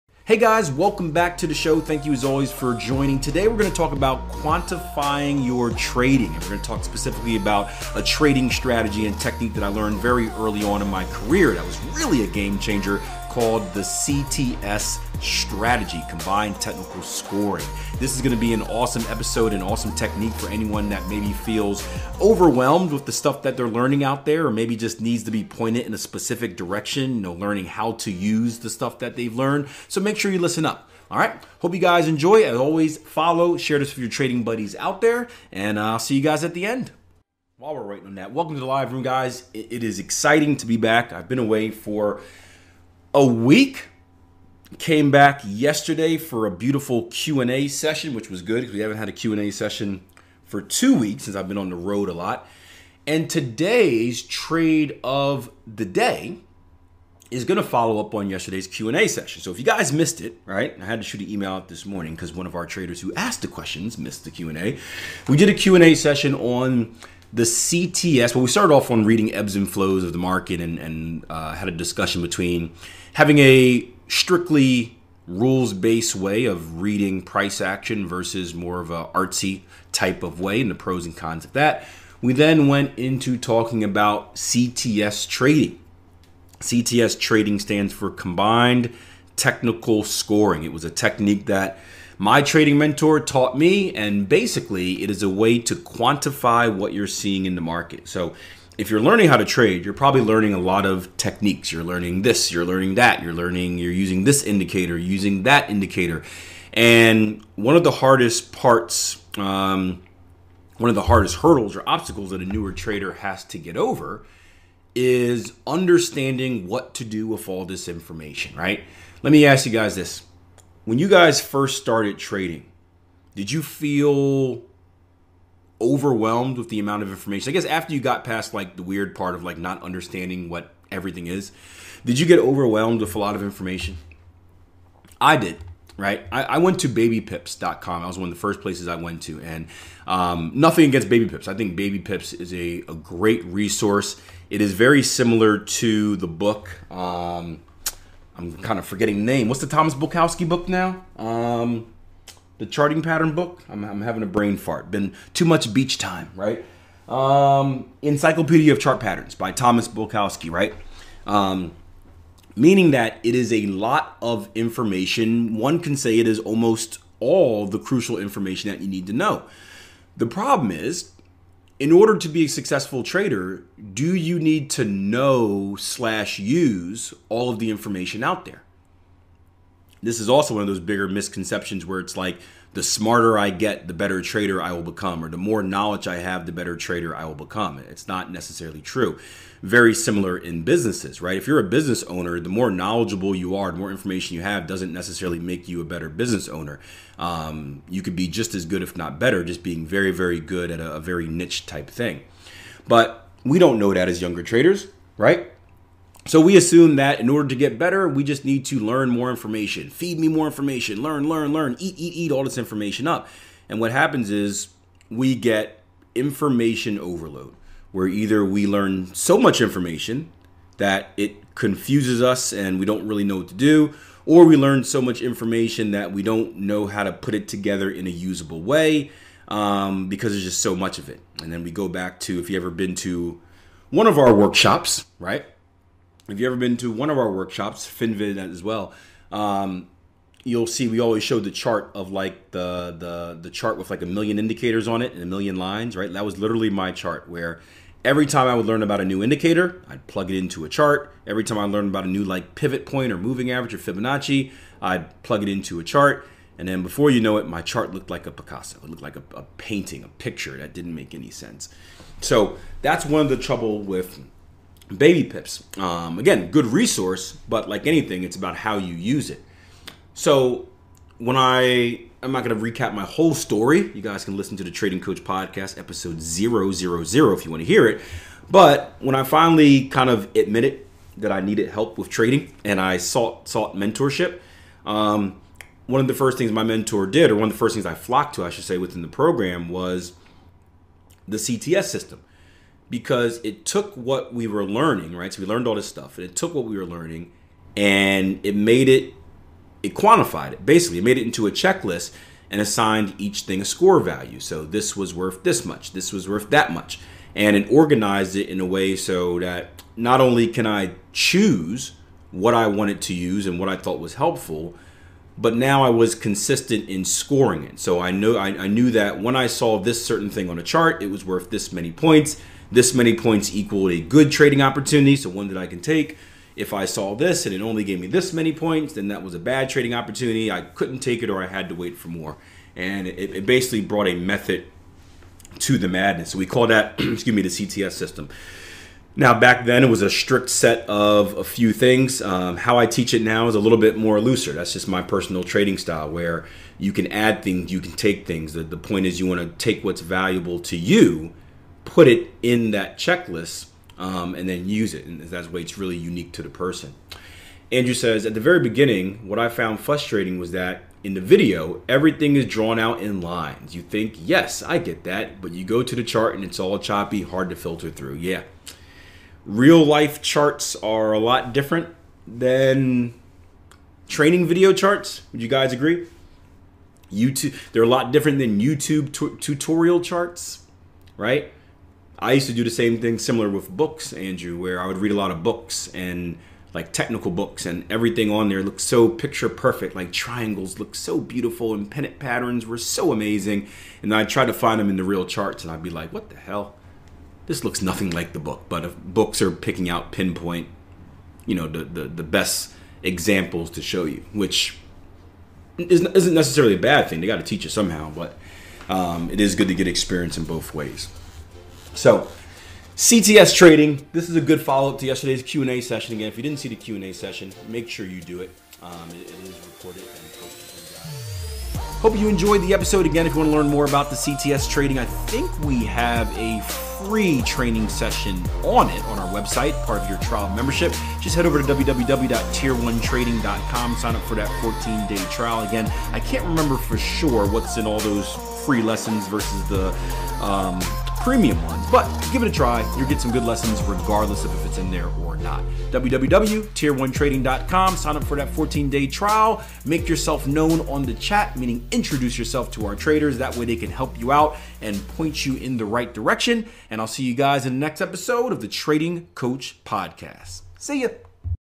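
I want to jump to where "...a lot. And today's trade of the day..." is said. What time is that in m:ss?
0:52.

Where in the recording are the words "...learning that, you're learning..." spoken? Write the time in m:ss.
1:42.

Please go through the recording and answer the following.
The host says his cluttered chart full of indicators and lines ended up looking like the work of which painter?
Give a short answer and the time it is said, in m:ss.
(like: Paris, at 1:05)
Picasso, at 4:18.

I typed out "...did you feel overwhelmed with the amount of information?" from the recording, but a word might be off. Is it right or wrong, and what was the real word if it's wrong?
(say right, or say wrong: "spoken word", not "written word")
right.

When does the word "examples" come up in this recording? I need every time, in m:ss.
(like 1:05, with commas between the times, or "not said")
6:43.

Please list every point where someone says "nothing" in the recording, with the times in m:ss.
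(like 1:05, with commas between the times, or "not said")
2:20, 6:37.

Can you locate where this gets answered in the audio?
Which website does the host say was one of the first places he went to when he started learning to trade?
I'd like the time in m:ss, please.
2:16.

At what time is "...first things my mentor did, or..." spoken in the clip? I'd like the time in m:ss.
4:46.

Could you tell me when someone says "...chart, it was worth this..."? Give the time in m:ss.
5:20.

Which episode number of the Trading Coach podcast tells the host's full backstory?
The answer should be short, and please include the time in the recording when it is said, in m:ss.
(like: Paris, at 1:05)
000, at 4:36.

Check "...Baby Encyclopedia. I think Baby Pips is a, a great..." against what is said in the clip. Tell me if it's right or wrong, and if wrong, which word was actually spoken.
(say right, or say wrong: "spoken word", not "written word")
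wrong: "Pips", not "Encyclopedia".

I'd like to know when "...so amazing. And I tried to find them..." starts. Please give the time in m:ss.
6:32.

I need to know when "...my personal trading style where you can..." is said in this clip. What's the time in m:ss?
5:44.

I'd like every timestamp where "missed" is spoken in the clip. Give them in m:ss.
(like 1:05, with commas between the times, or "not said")
0:59, 1:03.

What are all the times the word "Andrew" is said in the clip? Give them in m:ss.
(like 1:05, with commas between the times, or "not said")
5:57, 6:24.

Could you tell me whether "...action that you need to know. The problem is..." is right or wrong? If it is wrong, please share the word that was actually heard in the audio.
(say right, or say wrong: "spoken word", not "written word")
wrong: "information", not "action".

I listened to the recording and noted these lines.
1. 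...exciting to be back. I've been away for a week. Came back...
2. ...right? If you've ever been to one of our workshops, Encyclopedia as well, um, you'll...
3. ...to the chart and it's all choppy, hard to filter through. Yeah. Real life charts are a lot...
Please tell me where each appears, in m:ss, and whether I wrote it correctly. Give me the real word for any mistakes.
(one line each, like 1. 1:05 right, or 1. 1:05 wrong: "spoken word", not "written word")
1. 0:39 right
2. 3:55 wrong: "FinVid", not "Encyclopedia"
3. 6:05 right.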